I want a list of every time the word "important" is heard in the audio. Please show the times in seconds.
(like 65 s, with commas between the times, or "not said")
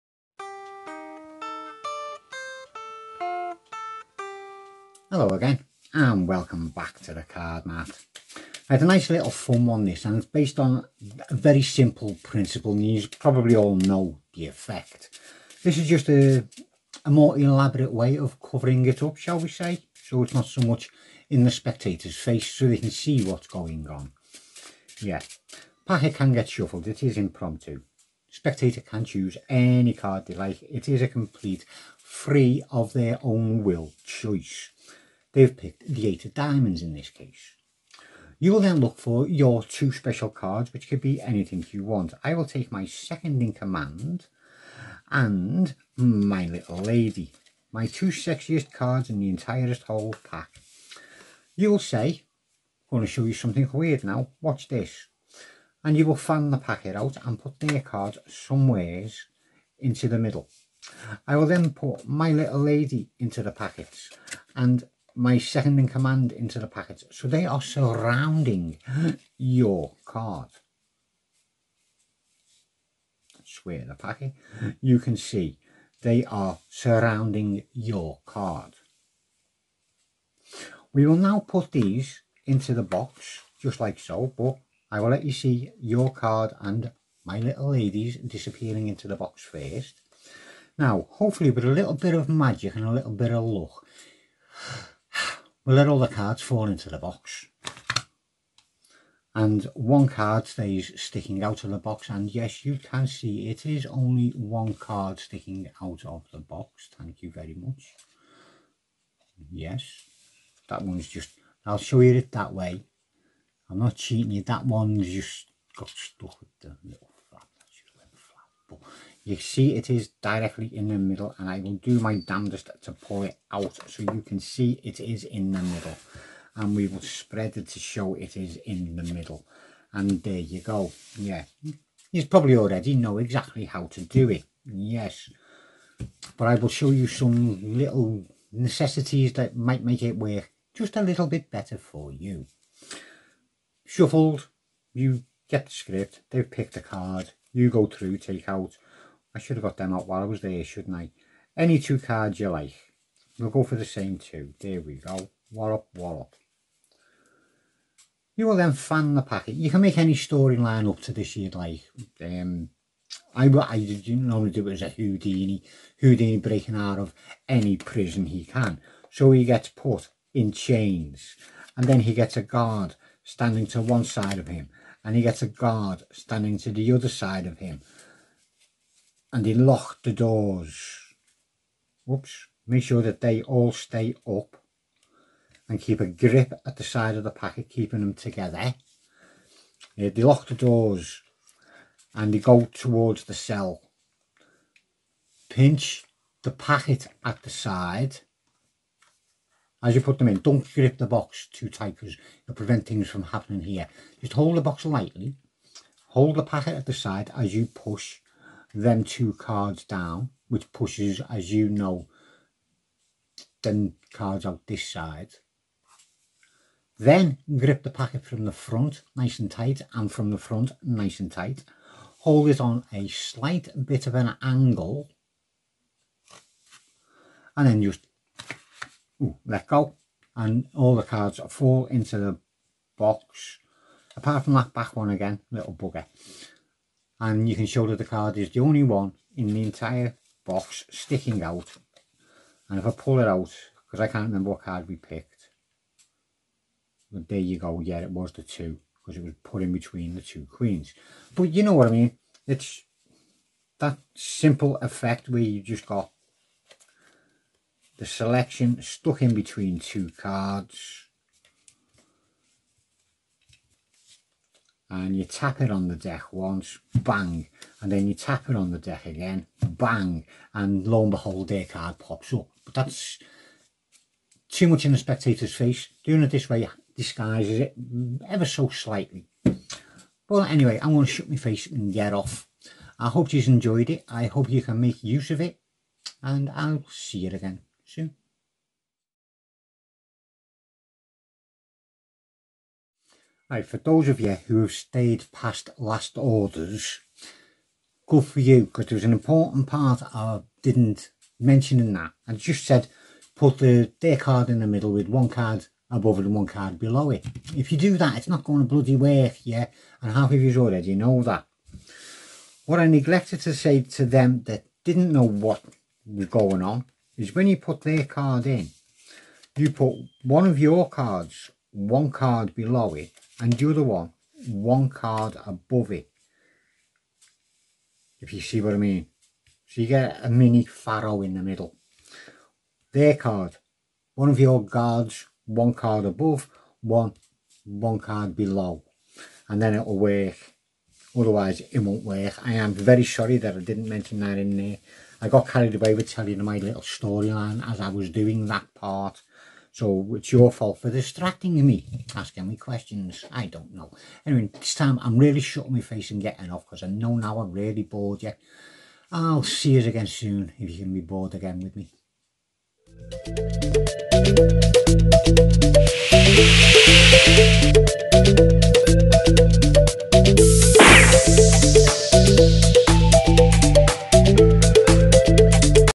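299 s.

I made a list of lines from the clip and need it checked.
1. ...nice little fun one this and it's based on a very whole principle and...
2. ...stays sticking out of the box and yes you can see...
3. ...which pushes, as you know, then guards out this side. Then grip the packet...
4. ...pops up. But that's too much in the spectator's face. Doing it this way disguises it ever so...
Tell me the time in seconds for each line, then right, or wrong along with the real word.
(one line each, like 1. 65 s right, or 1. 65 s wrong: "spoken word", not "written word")
1. 8 s wrong: "simple", not "whole"
2. 100 s right
3. 210 s wrong: "cards", not "guards"
4. 271 s right.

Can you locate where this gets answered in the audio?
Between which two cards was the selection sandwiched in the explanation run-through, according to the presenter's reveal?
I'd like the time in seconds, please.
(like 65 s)
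250 s.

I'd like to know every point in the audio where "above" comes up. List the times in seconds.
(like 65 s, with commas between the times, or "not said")
305 s, 325 s, 336 s.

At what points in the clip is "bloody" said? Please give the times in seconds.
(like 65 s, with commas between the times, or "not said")
308 s.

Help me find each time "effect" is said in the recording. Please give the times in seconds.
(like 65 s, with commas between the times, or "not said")
14 s, 254 s.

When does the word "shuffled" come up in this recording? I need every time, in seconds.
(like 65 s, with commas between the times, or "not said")
26 s, 143 s.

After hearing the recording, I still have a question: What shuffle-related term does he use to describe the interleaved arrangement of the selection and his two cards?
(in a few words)
mini faro.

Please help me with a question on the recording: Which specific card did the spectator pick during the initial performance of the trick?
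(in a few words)
eight of diamonds.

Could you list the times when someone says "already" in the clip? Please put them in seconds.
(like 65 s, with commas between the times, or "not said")
132 s, 310 s.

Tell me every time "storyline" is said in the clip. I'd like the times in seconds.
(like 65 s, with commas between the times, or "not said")
160 s, 346 s.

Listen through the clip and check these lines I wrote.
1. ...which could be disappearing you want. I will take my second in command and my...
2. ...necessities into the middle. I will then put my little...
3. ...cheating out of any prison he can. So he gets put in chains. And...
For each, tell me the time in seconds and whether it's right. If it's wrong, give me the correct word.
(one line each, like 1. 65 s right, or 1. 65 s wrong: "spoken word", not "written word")
1. 40 s wrong: "anything", not "disappearing"
2. 58 s wrong: "somewheres", not "necessities"
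3. 166 s wrong: "breaking", not "cheating".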